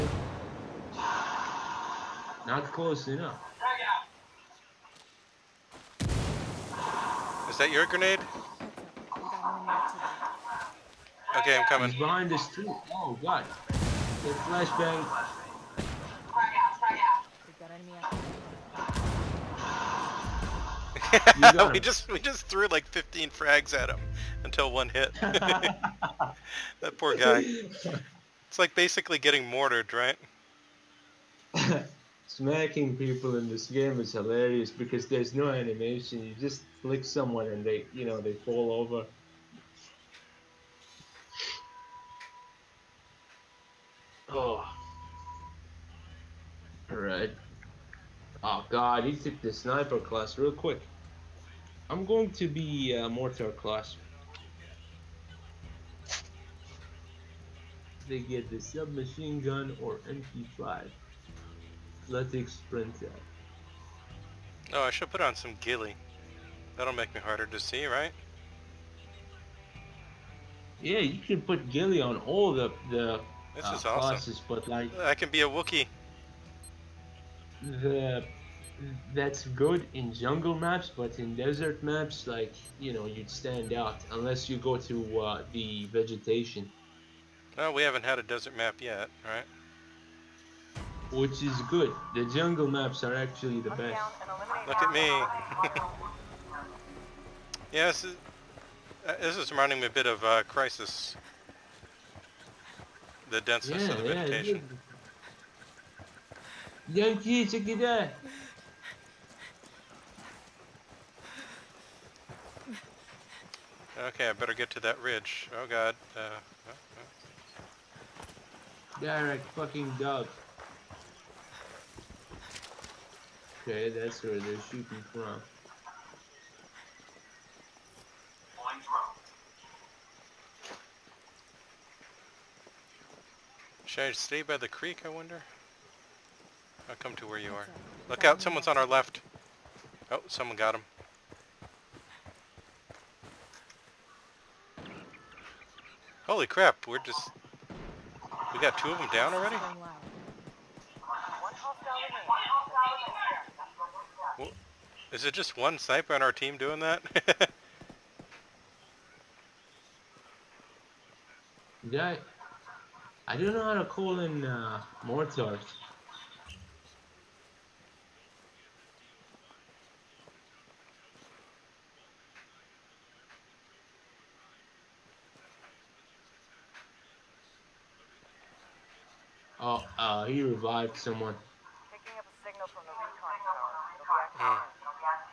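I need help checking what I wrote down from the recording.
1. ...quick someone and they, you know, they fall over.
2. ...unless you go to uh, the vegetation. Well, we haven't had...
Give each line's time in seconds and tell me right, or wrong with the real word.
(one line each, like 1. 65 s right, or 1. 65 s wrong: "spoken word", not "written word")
1. 36 s wrong: "flick", not "quick"
2. 84 s right.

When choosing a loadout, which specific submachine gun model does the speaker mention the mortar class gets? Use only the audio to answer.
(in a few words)
MP5.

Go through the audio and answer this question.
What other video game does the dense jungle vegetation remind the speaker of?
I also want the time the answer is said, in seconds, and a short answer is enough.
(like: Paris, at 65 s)
Crysis, at 100 s.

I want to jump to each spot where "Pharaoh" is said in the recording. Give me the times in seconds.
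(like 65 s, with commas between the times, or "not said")
not said.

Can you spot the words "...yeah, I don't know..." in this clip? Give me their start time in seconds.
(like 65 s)
161 s.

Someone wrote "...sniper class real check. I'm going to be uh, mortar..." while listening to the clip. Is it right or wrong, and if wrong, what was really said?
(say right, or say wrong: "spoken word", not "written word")
wrong: "quick", not "check".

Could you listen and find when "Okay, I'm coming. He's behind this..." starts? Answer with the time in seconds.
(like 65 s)
11 s.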